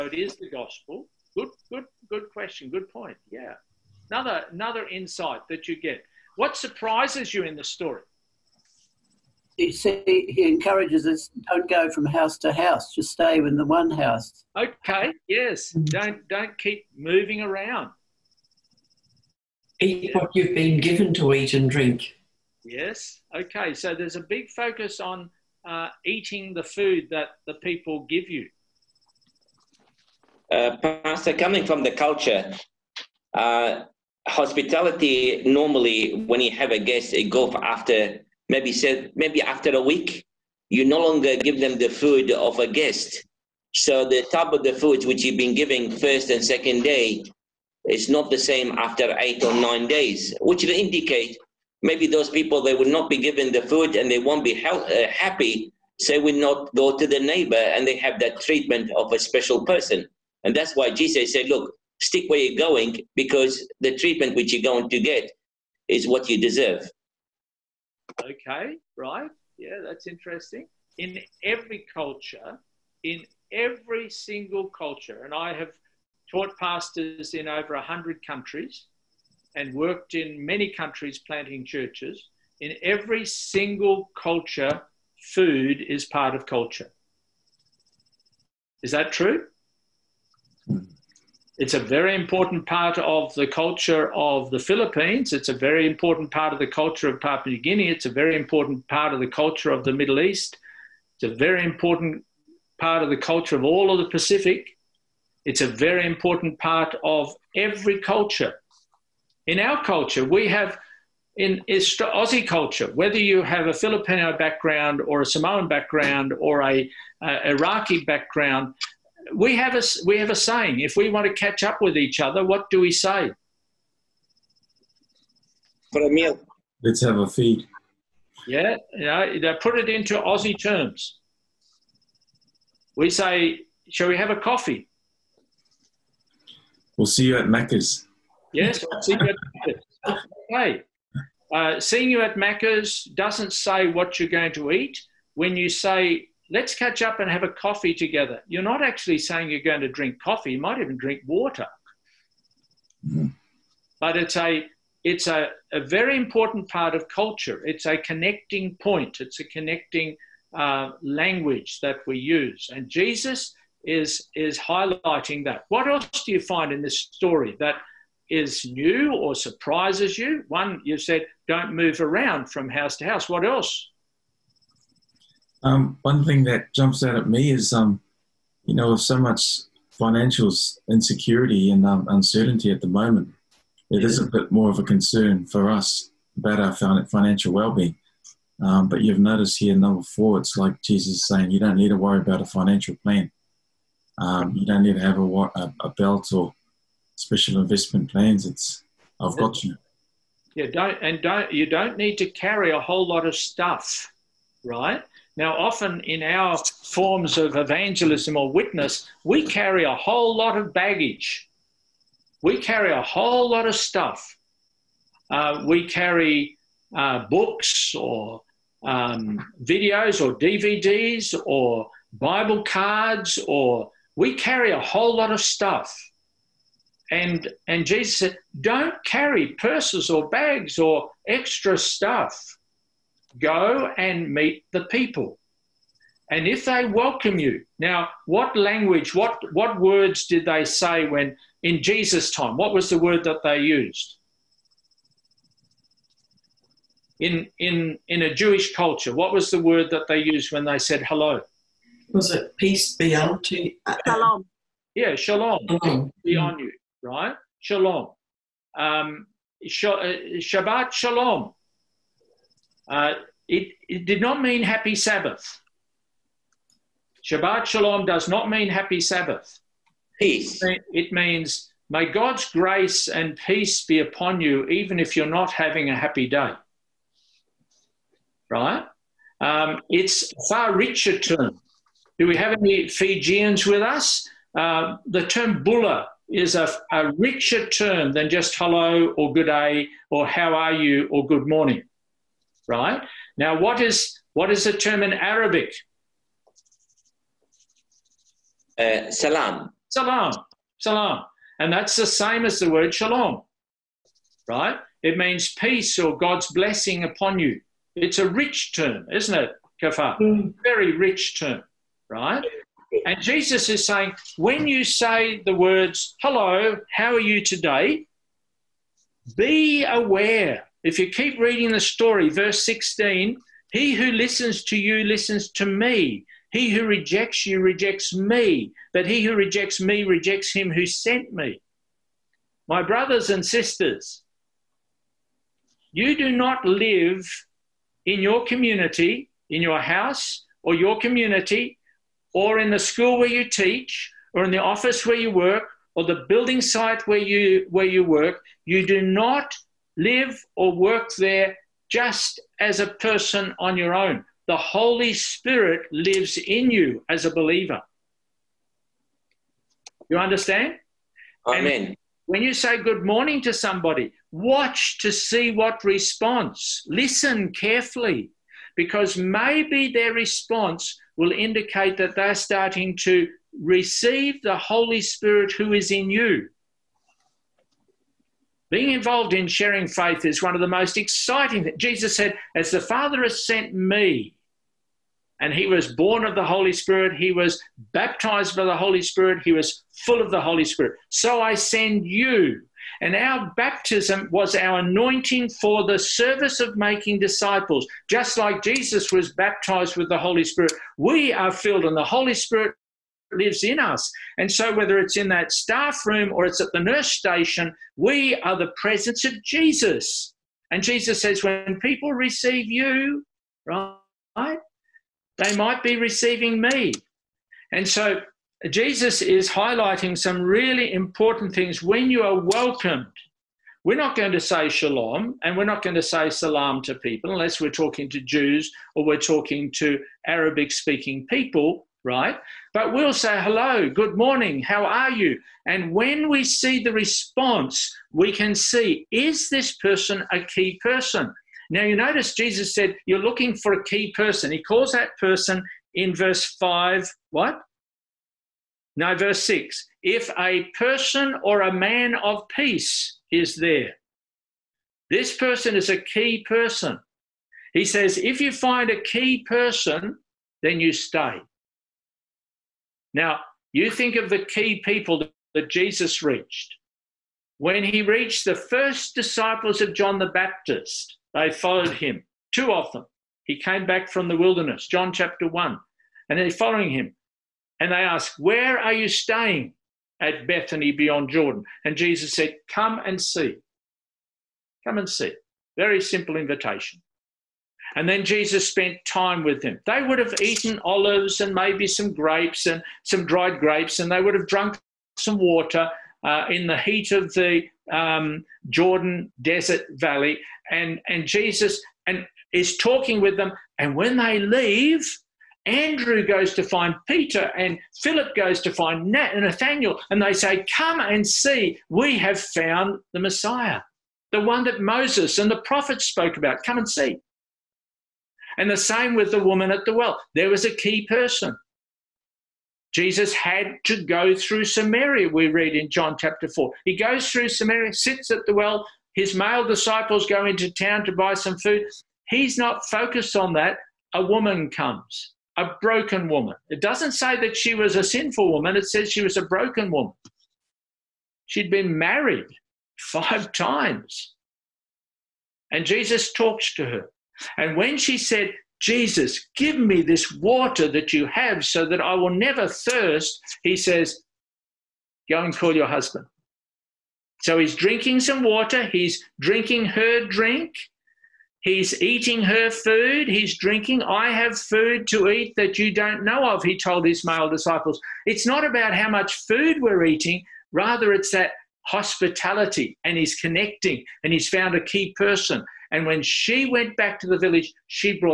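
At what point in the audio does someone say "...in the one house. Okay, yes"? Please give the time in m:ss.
0:13.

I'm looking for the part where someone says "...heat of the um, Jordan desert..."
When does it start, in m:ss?
8:16.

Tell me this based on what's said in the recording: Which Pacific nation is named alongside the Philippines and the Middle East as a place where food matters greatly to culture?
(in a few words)
Papua New Guinea.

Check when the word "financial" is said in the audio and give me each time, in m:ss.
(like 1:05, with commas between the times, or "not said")
2:59, 3:07, 3:12.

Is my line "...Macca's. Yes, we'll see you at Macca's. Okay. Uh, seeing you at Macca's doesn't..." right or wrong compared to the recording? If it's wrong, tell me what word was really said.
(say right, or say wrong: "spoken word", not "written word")
right.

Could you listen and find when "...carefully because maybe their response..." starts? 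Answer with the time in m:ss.
6:07.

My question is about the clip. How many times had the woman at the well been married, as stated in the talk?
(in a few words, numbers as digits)
5.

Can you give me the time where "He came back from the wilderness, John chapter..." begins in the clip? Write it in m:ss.
7:53.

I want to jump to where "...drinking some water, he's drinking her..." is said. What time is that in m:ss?
9:17.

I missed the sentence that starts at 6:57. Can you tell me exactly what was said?
And so, Jesus is highlighting some really important things when you are welcomed.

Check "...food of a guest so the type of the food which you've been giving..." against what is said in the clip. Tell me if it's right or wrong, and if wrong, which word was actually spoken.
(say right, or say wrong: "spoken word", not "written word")
right.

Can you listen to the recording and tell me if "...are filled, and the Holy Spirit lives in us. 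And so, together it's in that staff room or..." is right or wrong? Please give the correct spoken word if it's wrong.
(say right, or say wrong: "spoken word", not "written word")
wrong: "whether", not "together".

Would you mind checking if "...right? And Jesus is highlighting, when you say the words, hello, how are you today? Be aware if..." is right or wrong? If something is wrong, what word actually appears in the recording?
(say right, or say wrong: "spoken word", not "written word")
wrong: "saying", not "highlighting".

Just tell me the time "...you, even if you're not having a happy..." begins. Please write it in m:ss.
4:34.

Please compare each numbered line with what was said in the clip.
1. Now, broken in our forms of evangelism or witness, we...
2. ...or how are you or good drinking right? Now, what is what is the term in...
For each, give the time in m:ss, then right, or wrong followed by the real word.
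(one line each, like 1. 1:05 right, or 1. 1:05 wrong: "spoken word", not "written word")
1. 3:25 wrong: "often", not "broken"
2. 4:50 wrong: "morning", not "drinking".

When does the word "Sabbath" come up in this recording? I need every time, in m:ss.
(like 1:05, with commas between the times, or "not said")
4:24, 4:28.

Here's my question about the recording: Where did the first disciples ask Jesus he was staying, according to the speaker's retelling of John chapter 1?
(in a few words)
Bethany beyond Jordan.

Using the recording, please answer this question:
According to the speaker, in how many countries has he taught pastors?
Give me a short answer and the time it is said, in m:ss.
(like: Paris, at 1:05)
over 100, at 1:17.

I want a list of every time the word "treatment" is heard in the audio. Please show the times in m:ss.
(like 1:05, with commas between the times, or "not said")
0:58, 1:03.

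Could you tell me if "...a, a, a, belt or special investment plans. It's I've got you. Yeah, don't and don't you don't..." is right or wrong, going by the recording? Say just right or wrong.
right.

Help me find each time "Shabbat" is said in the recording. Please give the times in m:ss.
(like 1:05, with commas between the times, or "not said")
4:20, 4:27.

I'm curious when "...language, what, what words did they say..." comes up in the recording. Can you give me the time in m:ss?
3:58.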